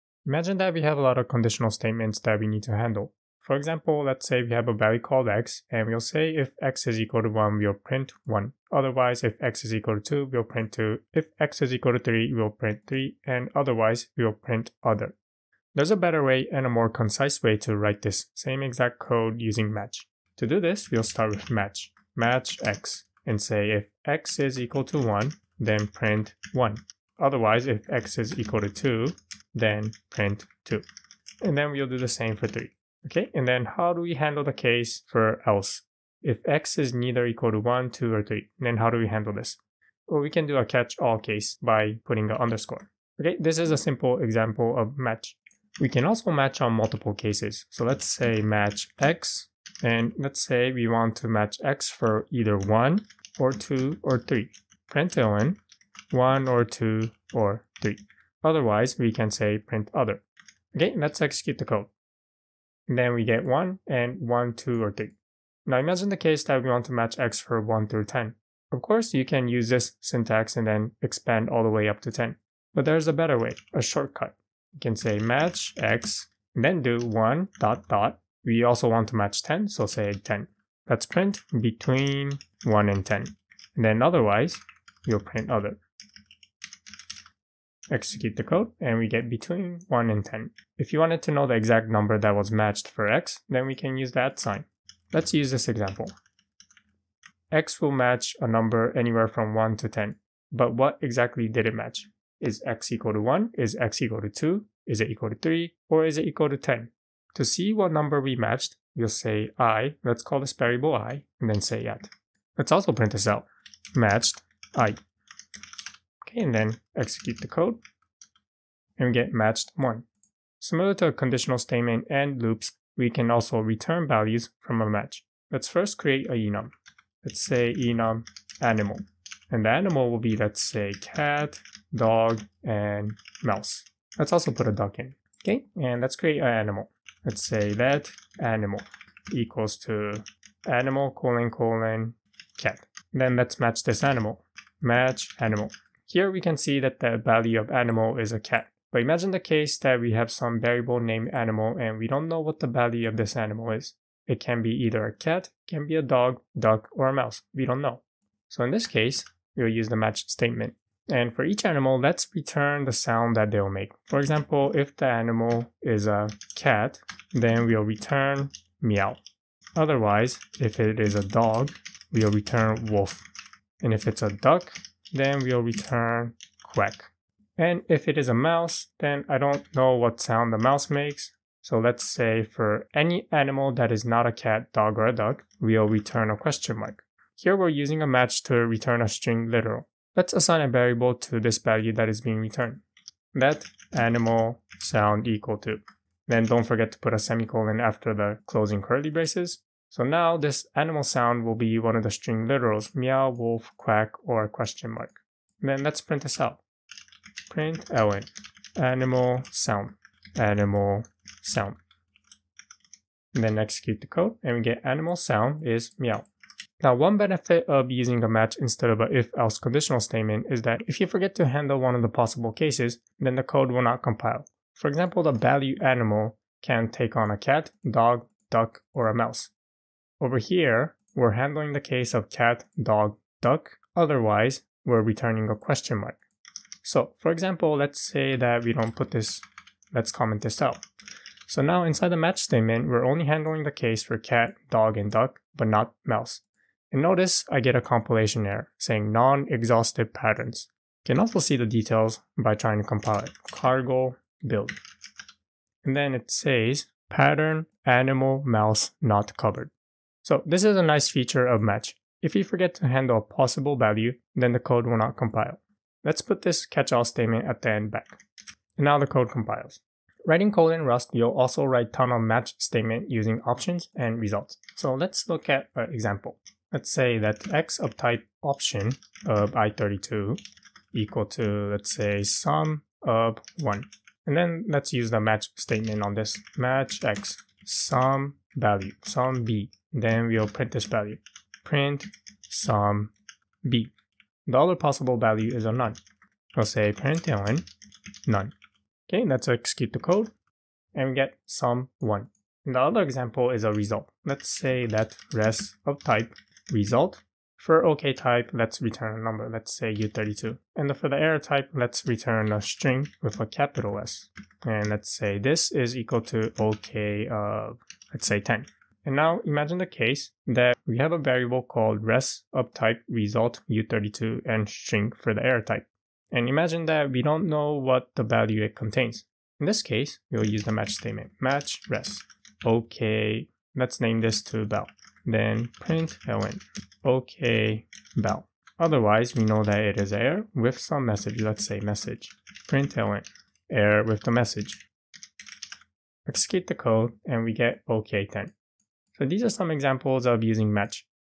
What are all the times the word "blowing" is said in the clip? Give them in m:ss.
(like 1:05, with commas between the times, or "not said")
not said.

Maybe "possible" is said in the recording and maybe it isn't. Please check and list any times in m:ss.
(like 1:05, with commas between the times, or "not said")
3:42, 4:23, 4:54.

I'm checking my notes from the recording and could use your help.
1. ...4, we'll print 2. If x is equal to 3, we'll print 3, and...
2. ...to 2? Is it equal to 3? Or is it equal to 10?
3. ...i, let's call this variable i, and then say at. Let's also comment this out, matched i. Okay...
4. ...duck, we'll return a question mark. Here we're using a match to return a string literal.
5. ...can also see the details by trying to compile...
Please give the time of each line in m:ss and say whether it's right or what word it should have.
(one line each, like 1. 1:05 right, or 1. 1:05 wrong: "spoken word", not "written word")
1. 0:10 wrong: "2", not "4"
2. 1:44 right
3. 1:49 wrong: "print", not "comment"
4. 3:05 right
5. 4:11 right.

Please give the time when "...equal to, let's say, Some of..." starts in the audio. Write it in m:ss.
4:40.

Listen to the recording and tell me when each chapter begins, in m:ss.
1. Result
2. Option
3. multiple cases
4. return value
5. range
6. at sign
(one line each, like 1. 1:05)
1. 5:04
2. 4:30
3. 0:45
4. 2:00
5. 1:06
6. 1:34.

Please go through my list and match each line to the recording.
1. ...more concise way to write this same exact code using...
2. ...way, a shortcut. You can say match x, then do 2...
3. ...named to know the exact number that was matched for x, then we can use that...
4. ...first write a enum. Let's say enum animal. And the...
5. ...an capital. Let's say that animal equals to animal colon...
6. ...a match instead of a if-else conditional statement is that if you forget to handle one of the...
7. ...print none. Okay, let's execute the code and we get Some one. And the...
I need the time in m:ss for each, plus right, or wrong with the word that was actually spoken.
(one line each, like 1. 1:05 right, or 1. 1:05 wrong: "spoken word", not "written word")
1. 0:16 right
2. 1:13 wrong: "1", not "2"
3. 1:30 wrong: "wanted", not "named"
4. 2:05 wrong: "create", not "write"
5. 2:16 wrong: "animal", not "capital"
6. 3:38 right
7. 4:56 right.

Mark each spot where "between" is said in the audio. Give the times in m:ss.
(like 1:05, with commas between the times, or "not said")
1:21, 1:29.